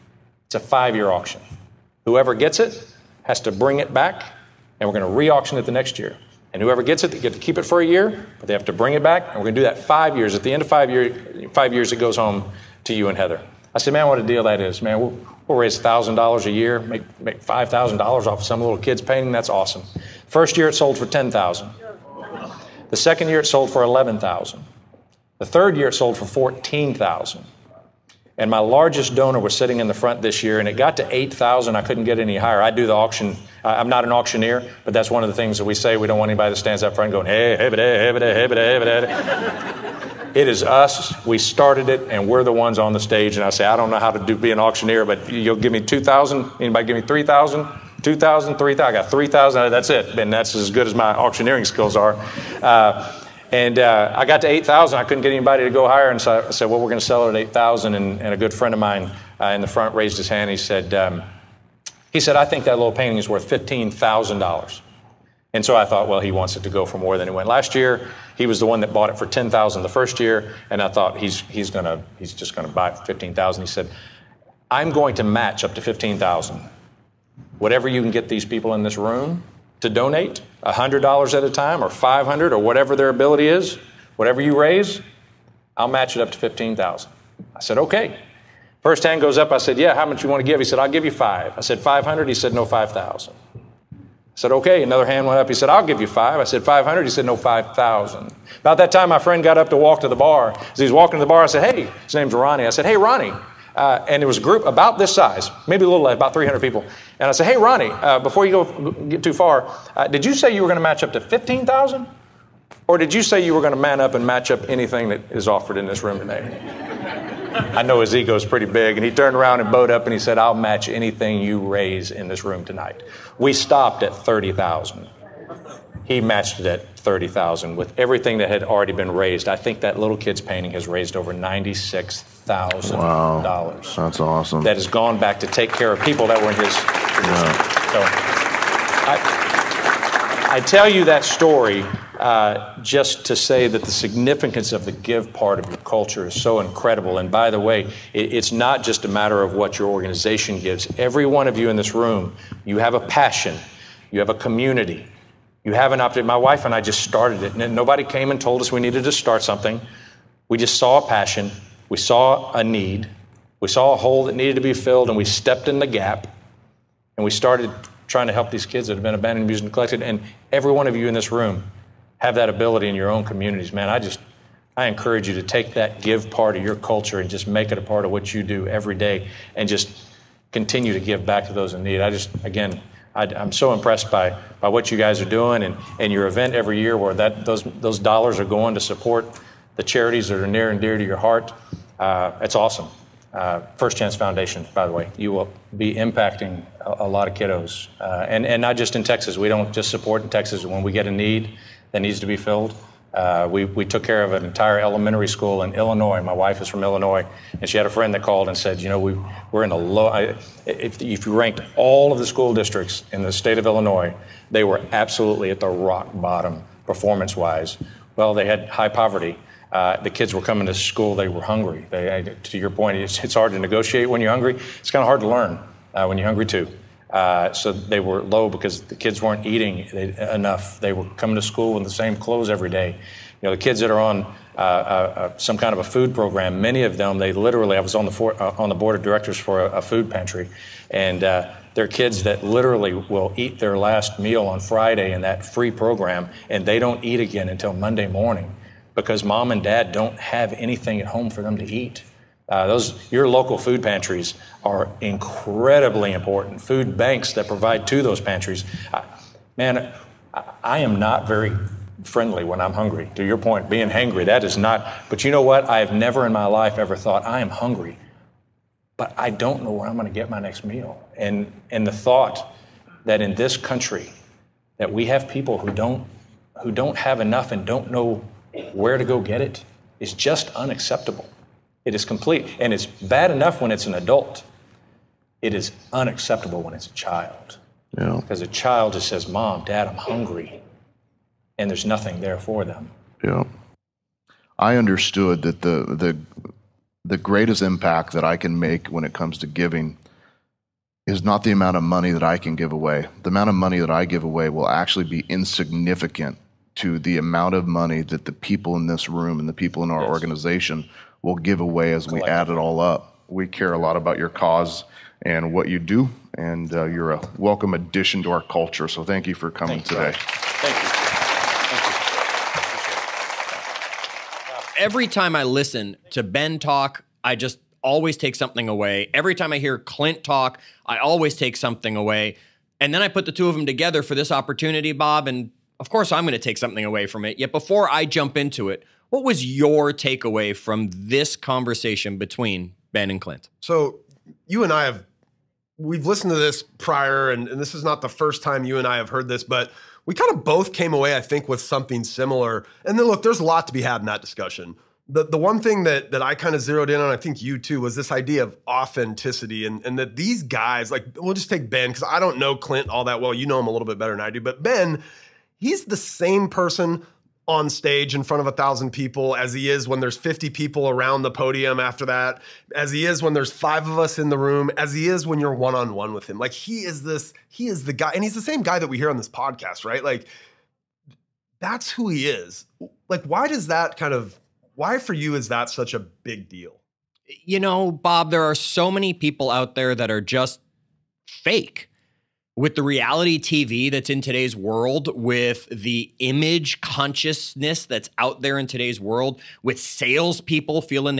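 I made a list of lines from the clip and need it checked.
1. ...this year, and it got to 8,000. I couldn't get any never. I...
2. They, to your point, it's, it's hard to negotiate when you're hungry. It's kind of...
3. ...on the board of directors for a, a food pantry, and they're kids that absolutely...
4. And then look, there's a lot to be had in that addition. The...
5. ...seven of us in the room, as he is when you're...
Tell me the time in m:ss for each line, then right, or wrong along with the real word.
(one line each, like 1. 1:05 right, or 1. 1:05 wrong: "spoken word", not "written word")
1. 0:30 wrong: "higher", not "never"
2. 3:41 right
3. 3:58 wrong: "literally", not "absolutely"
4. 5:52 wrong: "discussion", not "addition"
5. 6:13 wrong: "five", not "seven".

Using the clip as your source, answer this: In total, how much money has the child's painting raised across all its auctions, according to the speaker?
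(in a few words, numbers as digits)
$96,000.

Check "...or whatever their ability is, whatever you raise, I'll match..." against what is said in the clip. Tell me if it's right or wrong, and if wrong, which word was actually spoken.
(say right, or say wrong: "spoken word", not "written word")
right.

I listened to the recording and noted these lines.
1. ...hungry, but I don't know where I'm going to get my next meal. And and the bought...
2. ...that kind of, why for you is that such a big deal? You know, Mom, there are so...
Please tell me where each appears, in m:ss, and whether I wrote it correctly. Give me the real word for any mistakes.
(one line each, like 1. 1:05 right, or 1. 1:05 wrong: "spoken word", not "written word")
1. 4:27 wrong: "thought", not "bought"
2. 6:23 wrong: "Bob", not "Mom".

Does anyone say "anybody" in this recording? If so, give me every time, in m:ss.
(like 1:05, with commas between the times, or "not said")
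0:36, 0:46, 0:55.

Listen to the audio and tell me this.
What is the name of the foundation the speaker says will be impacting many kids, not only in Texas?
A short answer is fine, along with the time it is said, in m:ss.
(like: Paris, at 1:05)
First Chance Foundation, at 3:13.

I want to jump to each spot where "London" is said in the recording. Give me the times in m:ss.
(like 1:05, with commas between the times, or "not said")
not said.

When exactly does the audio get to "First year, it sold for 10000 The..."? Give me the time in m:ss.
0:20.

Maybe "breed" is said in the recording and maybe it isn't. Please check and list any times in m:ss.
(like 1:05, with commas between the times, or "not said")
not said.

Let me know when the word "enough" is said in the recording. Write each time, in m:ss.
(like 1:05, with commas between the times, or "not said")
3:50, 4:37, 4:43.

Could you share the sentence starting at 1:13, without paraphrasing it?
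He said, I'm going to match up to 15,000.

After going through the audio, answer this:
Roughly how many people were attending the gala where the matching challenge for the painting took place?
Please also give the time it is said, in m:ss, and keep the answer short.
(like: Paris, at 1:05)
300, at 1:46.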